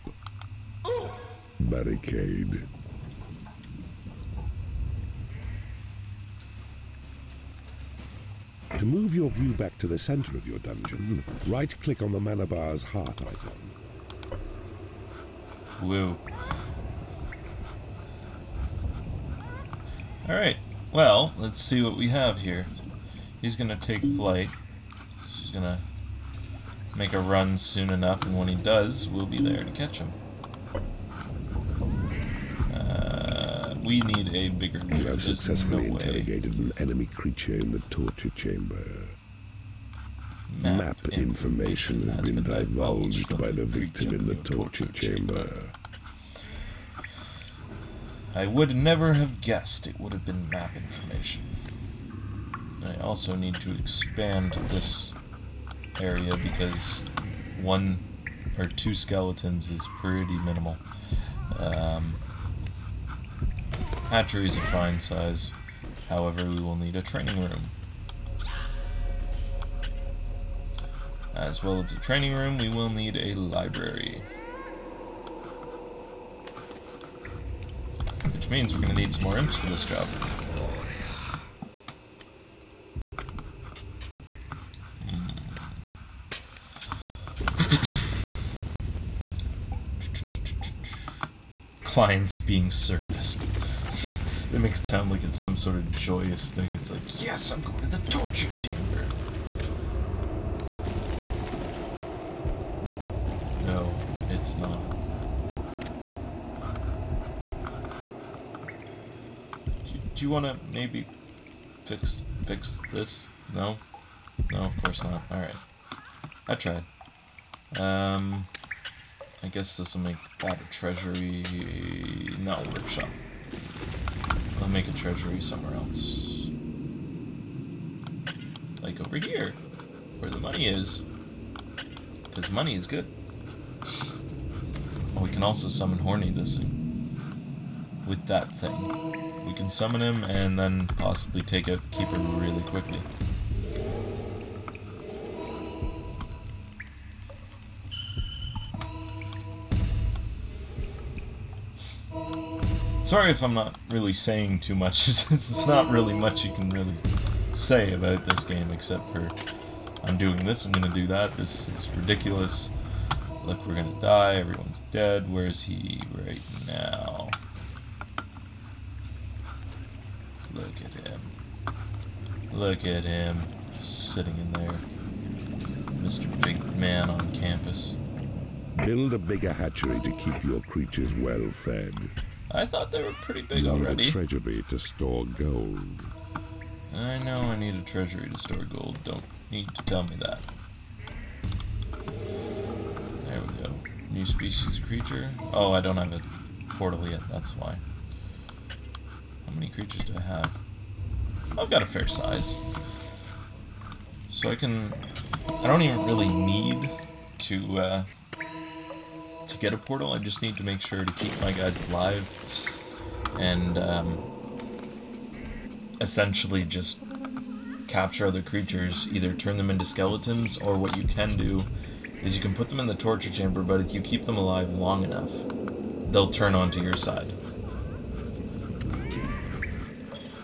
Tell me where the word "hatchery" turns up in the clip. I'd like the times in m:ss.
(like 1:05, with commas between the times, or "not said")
1:04, 2:59.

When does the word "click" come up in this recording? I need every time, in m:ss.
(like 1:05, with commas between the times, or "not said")
0:11.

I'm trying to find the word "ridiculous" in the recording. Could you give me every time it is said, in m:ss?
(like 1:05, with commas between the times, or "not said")
2:41.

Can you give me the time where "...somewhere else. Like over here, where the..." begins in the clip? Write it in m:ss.
2:05.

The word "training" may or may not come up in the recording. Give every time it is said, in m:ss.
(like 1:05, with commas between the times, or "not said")
1:07, 1:11.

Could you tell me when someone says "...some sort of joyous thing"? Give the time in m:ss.
1:35.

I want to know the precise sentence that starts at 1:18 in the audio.
Which means we're gonna need some more imps for this job.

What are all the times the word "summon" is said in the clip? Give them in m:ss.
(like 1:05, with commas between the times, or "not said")
2:15, 2:19.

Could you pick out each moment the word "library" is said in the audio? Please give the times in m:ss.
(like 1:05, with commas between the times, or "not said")
1:13.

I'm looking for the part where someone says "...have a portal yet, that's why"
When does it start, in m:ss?
3:15.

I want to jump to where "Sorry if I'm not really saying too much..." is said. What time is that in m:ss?
2:33.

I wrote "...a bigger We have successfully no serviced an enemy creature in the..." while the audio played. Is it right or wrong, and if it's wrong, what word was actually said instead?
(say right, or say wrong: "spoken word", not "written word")
wrong: "interrogated", not "serviced".